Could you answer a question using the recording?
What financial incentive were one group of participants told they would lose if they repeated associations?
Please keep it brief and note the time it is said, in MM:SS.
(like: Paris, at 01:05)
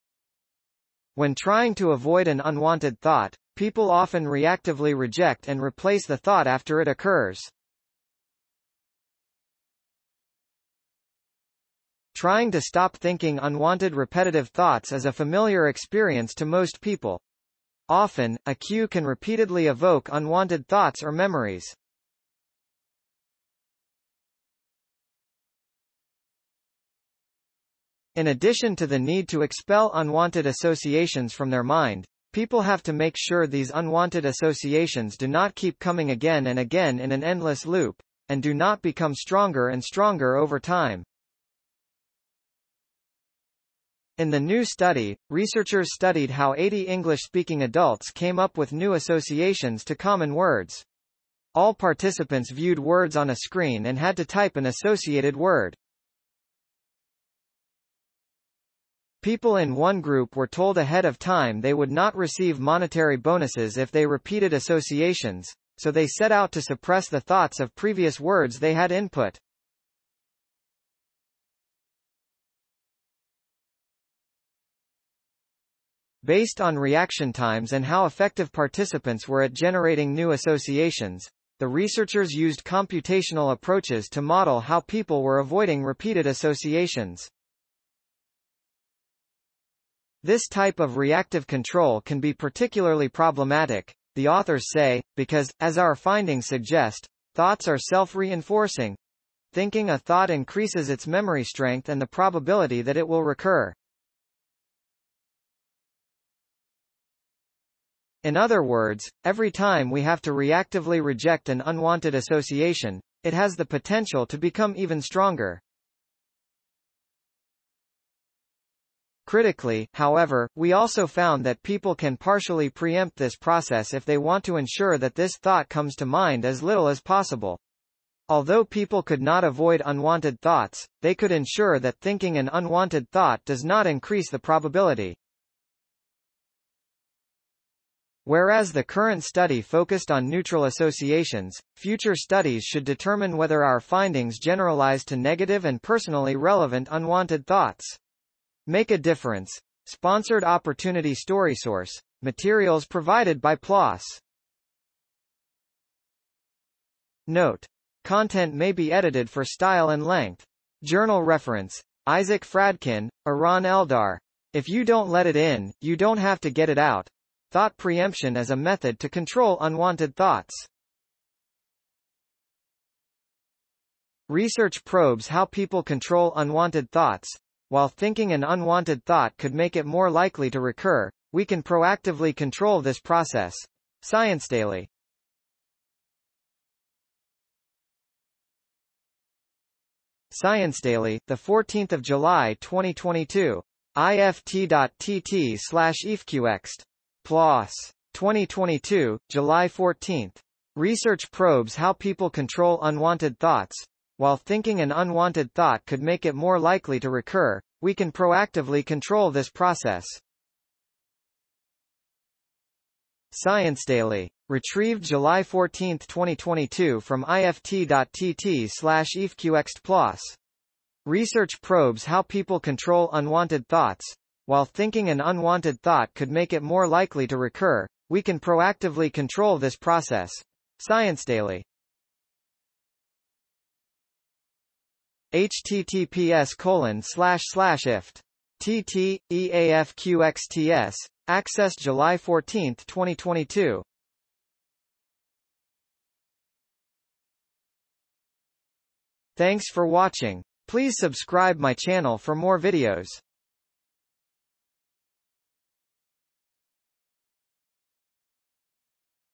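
monetary bonuses, at 01:02.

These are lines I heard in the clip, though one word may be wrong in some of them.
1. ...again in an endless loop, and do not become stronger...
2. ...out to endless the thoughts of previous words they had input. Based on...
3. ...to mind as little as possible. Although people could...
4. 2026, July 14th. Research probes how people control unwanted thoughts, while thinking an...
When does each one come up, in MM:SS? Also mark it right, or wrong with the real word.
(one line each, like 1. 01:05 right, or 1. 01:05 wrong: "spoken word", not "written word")
1. 00:36 right
2. 01:06 wrong: "suppress", not "endless"
3. 02:05 right
4. 03:18 wrong: "2022", not "2026".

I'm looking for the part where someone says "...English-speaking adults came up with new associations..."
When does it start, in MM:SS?
00:46.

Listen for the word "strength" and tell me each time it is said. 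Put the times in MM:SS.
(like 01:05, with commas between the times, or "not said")
01:41.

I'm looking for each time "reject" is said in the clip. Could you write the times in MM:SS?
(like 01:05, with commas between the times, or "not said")
00:04, 01:51.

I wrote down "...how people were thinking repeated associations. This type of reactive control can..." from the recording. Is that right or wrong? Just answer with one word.
wrong.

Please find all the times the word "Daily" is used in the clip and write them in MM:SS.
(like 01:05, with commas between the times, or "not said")
03:04, 03:10, 03:33, 03:51.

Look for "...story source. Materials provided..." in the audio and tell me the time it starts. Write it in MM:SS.
02:31.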